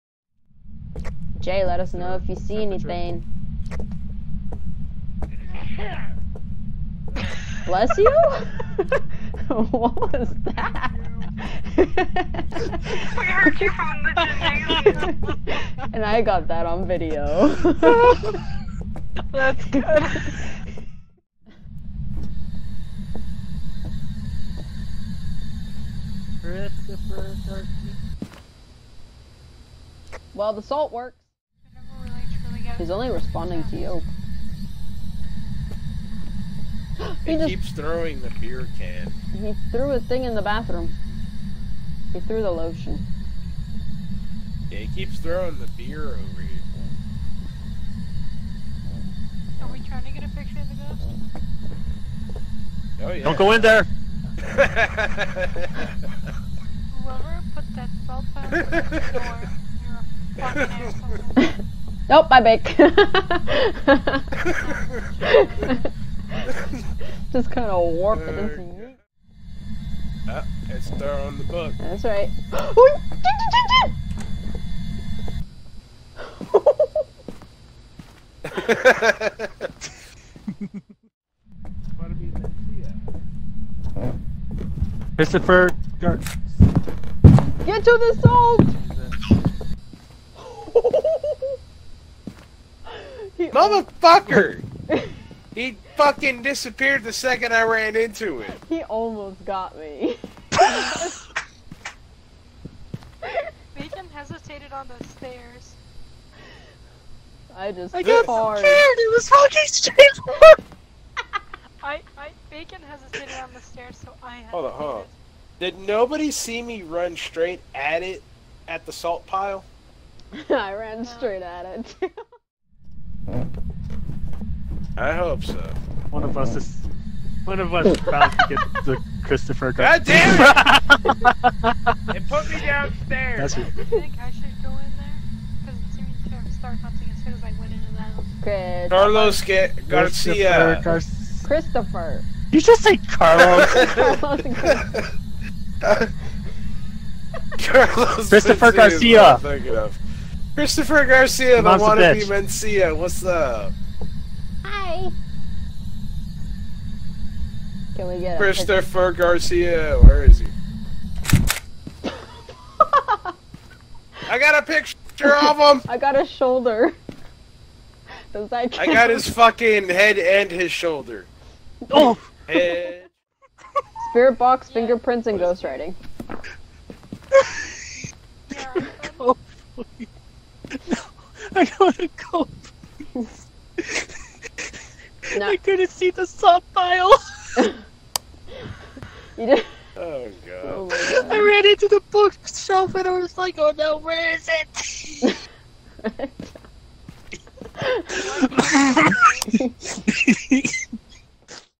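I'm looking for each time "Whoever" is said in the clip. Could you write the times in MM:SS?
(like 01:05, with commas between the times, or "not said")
00:53.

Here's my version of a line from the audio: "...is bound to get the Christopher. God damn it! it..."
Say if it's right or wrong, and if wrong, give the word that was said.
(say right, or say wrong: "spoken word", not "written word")
right.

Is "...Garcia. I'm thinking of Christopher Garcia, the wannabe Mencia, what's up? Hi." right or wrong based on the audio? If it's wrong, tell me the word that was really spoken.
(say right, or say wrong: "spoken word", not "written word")
right.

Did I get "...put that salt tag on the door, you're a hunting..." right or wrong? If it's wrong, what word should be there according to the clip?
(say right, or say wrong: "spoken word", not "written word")
wrong: "fucking", not "hunting".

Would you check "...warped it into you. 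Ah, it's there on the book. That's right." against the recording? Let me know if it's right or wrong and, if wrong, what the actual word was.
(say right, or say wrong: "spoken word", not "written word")
right.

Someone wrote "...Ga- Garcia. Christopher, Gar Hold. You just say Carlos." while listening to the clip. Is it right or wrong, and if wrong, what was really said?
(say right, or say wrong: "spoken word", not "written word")
wrong: "Christopher", not "Hold".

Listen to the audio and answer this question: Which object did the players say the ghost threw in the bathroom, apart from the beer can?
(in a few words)
lotion.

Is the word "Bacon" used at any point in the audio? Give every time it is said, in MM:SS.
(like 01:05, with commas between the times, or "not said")
01:43, 01:52.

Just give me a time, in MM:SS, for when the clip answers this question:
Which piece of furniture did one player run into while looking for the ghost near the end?
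03:11.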